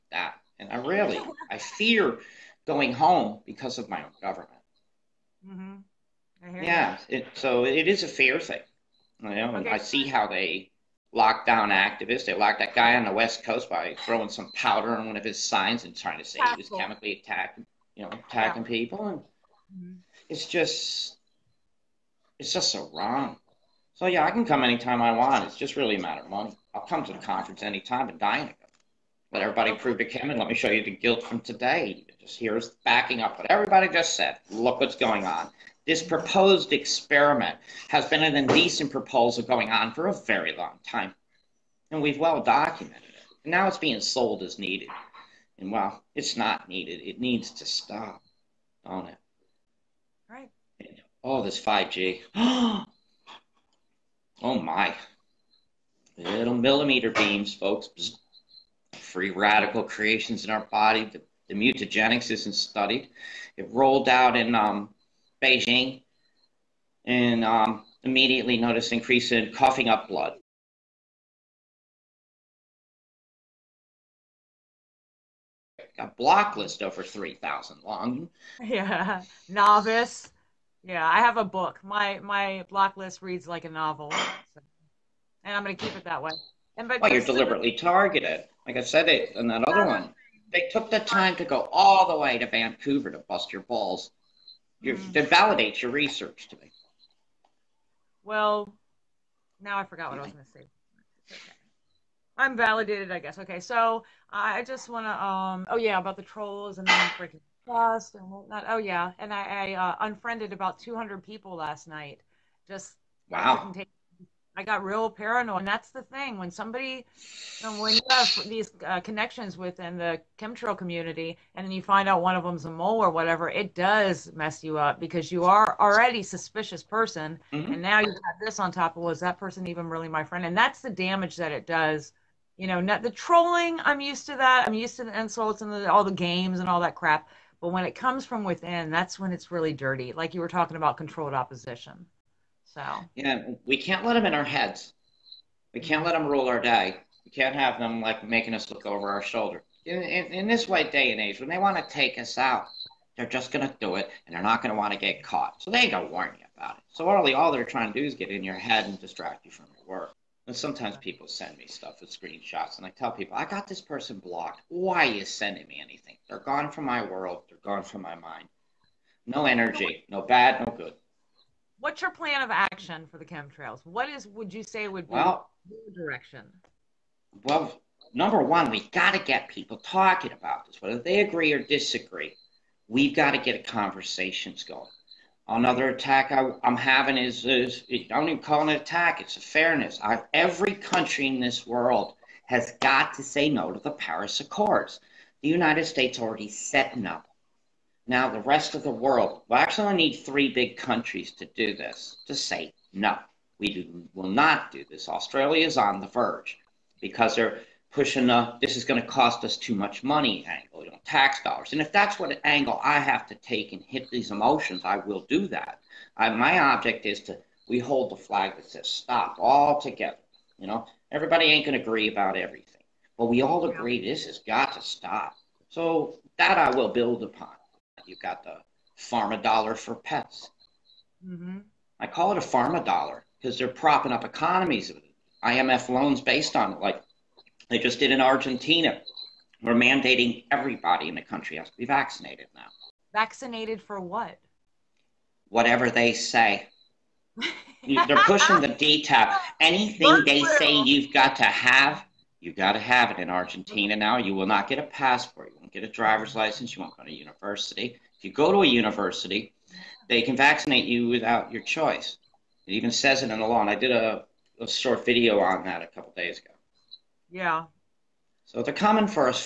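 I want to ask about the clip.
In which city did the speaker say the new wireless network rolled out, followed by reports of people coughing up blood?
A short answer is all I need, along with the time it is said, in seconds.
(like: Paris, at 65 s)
Beijing, at 65 s.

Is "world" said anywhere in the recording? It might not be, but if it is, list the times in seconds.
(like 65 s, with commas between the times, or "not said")
167 s, 191 s, 198 s.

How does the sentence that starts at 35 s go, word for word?
This proposed experiment has been an indecent proposal going on for a very long time, and we've well documented it.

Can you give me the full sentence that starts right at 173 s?
What is would you say would be well, your direction?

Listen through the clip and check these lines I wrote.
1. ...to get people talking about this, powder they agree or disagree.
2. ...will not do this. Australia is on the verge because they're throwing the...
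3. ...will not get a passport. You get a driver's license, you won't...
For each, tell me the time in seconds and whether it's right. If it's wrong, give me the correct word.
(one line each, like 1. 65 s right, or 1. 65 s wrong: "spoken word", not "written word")
1. 179 s wrong: "whether", not "powder"
2. 204 s wrong: "pushing", not "throwing"
3. 254 s right.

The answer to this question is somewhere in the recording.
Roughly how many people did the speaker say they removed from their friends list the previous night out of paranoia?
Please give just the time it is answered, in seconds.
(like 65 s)
110 s.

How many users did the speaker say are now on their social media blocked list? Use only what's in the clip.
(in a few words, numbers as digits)
over 3,000.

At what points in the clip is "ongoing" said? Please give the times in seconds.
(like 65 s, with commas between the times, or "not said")
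not said.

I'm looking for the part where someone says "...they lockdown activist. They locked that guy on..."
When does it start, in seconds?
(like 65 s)
10 s.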